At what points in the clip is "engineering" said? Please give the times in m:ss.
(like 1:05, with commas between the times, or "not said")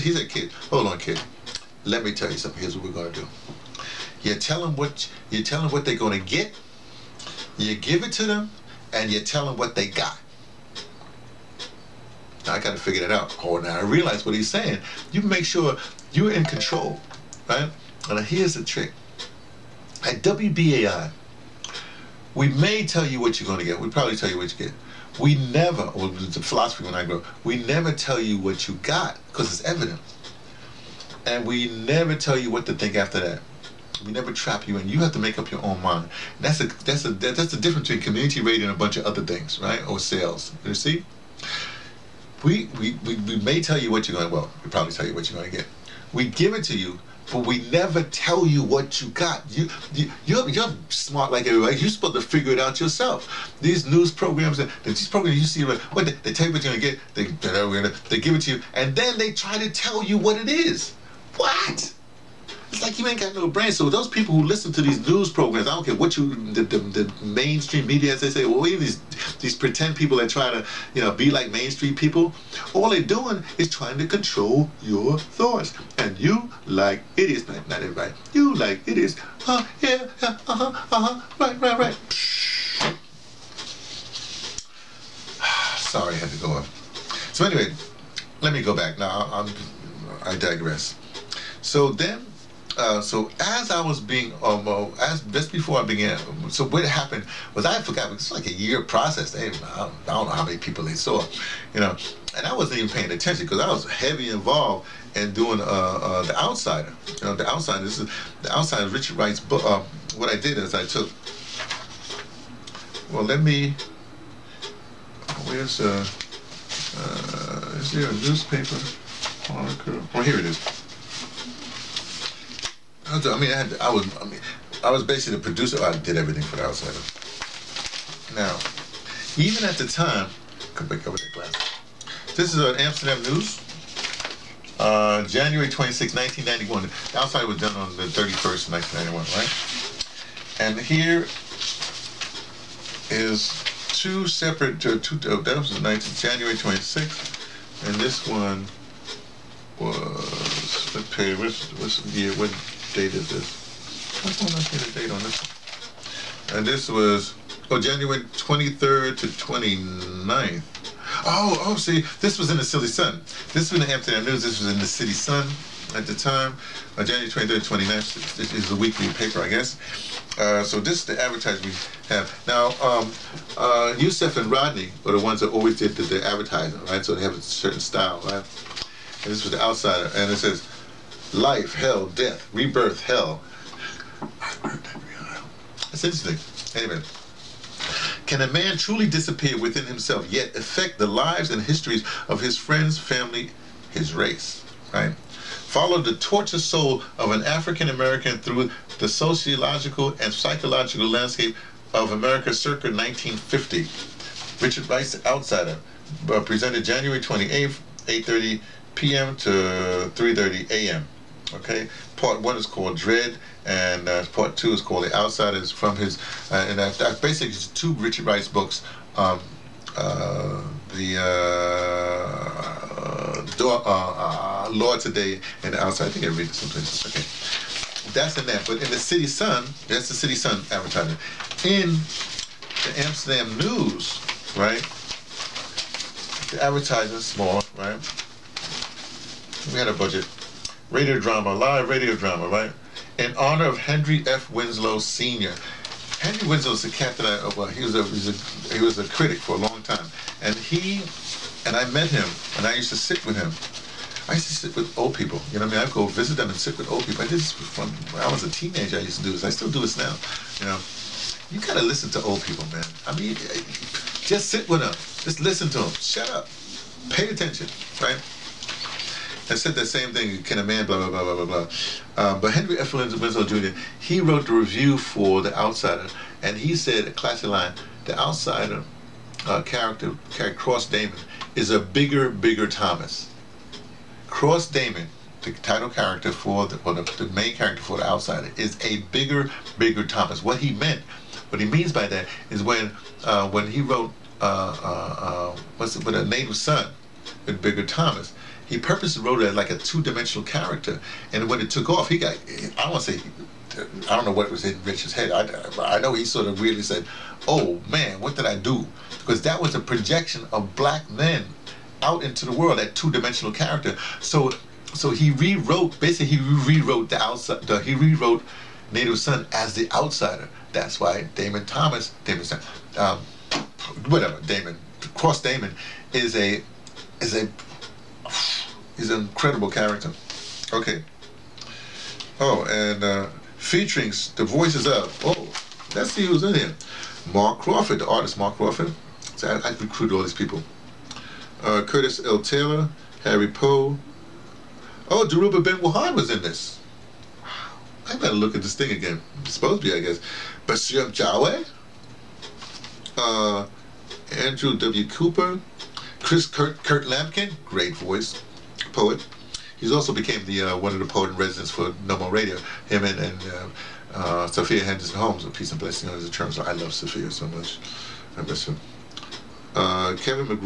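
not said.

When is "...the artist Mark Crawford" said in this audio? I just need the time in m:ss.
5:38.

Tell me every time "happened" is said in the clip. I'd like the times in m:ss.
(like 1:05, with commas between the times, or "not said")
1:36.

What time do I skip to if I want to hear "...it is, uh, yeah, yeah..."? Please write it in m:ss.
1:18.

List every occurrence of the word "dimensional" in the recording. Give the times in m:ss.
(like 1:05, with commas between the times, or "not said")
4:59, 5:12.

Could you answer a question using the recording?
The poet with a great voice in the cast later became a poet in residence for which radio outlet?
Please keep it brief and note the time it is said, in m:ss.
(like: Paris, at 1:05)
Nommo Radio, at 6:02.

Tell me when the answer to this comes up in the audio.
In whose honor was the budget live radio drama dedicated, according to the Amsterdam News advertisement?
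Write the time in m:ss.
4:03.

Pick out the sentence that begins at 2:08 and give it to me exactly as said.
Now, even at the time, come back over that glass.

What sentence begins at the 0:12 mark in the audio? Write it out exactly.
Now I gotta figure that out.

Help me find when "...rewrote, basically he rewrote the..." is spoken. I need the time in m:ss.
5:15.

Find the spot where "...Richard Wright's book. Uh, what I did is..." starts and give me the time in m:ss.
1:48.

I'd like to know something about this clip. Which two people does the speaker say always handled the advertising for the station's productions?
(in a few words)
Youssef and Rodney.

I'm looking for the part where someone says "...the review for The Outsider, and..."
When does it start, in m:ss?
4:34.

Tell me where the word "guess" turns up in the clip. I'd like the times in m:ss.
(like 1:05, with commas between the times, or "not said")
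2:49, 5:50.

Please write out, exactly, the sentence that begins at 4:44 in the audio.
Cross Damon, the title character for the, well, the, the main character for The Outsider, is a bigger, Bigger Thomas.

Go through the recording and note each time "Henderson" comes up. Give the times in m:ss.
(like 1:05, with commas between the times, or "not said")
6:04.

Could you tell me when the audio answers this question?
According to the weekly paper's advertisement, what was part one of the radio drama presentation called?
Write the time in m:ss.
3:32.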